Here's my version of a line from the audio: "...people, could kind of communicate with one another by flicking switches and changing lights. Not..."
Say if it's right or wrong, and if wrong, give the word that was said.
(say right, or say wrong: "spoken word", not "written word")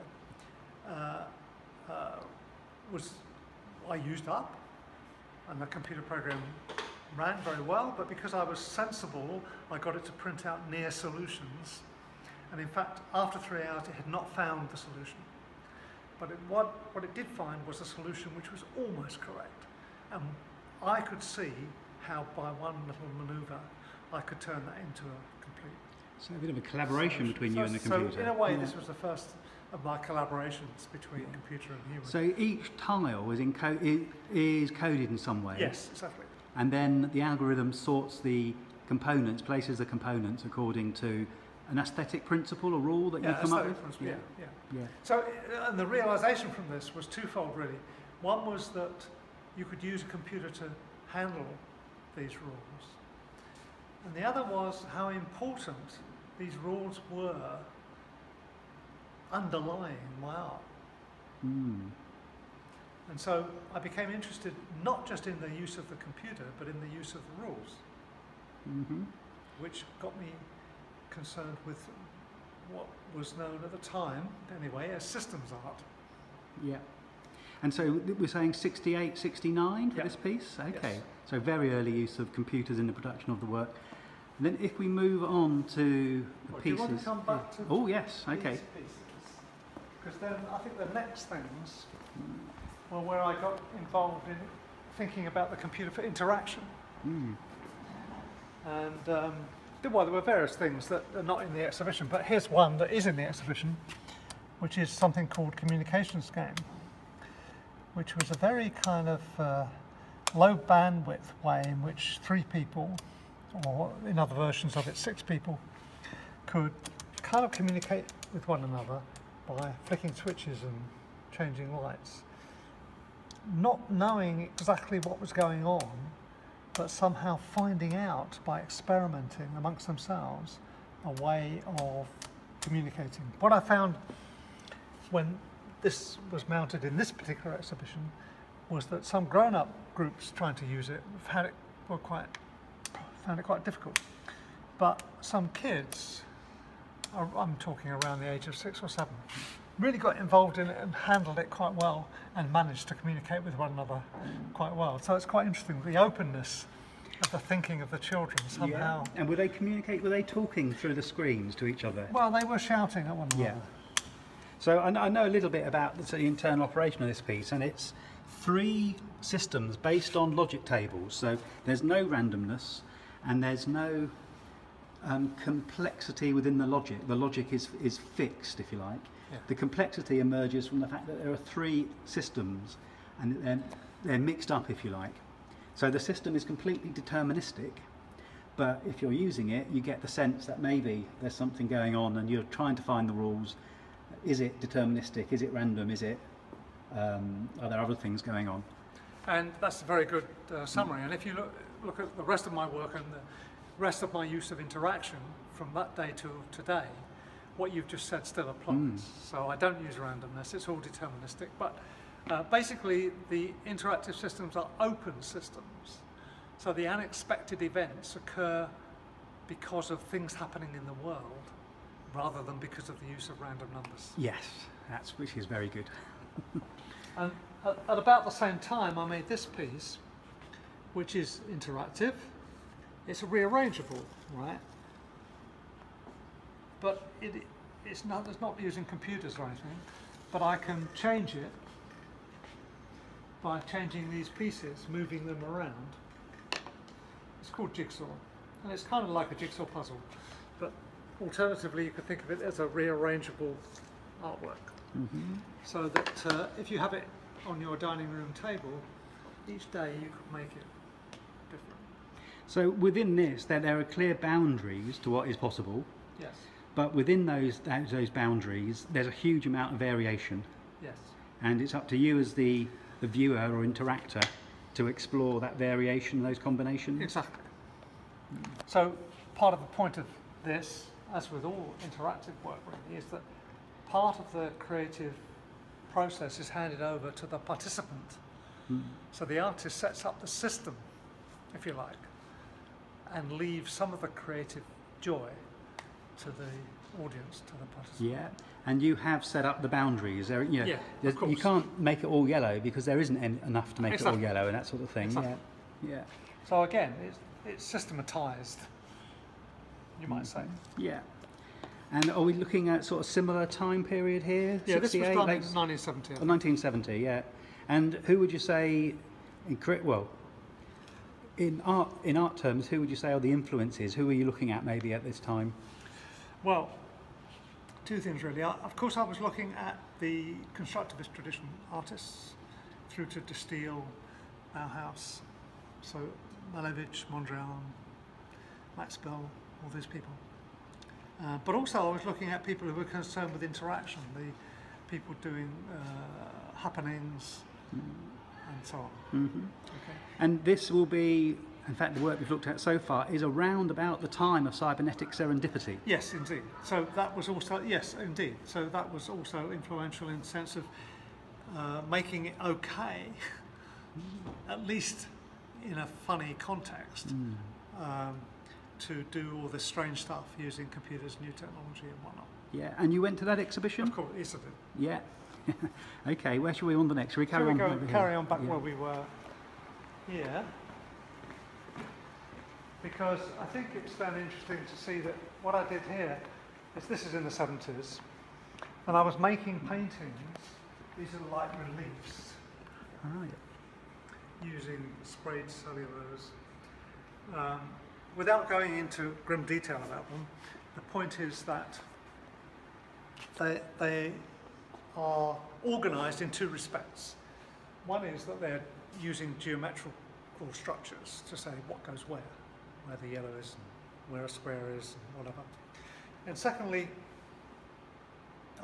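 right.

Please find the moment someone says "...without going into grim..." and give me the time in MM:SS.
06:38.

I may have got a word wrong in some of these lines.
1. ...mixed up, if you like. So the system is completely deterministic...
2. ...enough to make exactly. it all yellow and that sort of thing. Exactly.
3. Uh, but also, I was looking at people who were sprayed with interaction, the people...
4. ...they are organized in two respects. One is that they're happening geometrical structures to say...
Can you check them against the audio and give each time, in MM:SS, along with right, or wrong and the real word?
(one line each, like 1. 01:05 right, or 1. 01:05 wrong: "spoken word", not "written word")
1. 03:04 right
2. 05:03 right
3. 05:41 wrong: "concerned", not "sprayed"
4. 06:43 wrong: "using", not "happening".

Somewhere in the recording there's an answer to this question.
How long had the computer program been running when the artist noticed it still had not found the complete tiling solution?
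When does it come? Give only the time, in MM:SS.
00:13.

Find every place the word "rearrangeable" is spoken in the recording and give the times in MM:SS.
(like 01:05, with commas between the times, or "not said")
03:53, 04:12.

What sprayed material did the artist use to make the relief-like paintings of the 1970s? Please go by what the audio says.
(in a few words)
Cellulose.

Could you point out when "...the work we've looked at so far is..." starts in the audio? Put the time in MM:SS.
05:51.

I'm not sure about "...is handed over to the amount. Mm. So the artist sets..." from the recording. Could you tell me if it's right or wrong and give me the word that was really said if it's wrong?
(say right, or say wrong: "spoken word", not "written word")
wrong: "participant", not "amount".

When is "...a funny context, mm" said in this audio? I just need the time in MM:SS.
06:05.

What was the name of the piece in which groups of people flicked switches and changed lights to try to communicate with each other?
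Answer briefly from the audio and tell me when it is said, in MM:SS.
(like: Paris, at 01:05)
Communications Game, at 01:45.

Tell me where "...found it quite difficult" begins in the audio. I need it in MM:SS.
02:23.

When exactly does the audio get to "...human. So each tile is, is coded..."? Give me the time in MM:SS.
00:31.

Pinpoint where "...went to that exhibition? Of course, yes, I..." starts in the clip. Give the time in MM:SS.
06:13.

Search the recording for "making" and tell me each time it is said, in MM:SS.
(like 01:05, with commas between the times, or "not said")
06:01, 06:29.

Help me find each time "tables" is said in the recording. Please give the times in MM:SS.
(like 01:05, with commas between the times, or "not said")
02:50, 04:18.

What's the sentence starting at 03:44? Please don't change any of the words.
Yes, that's which is very good.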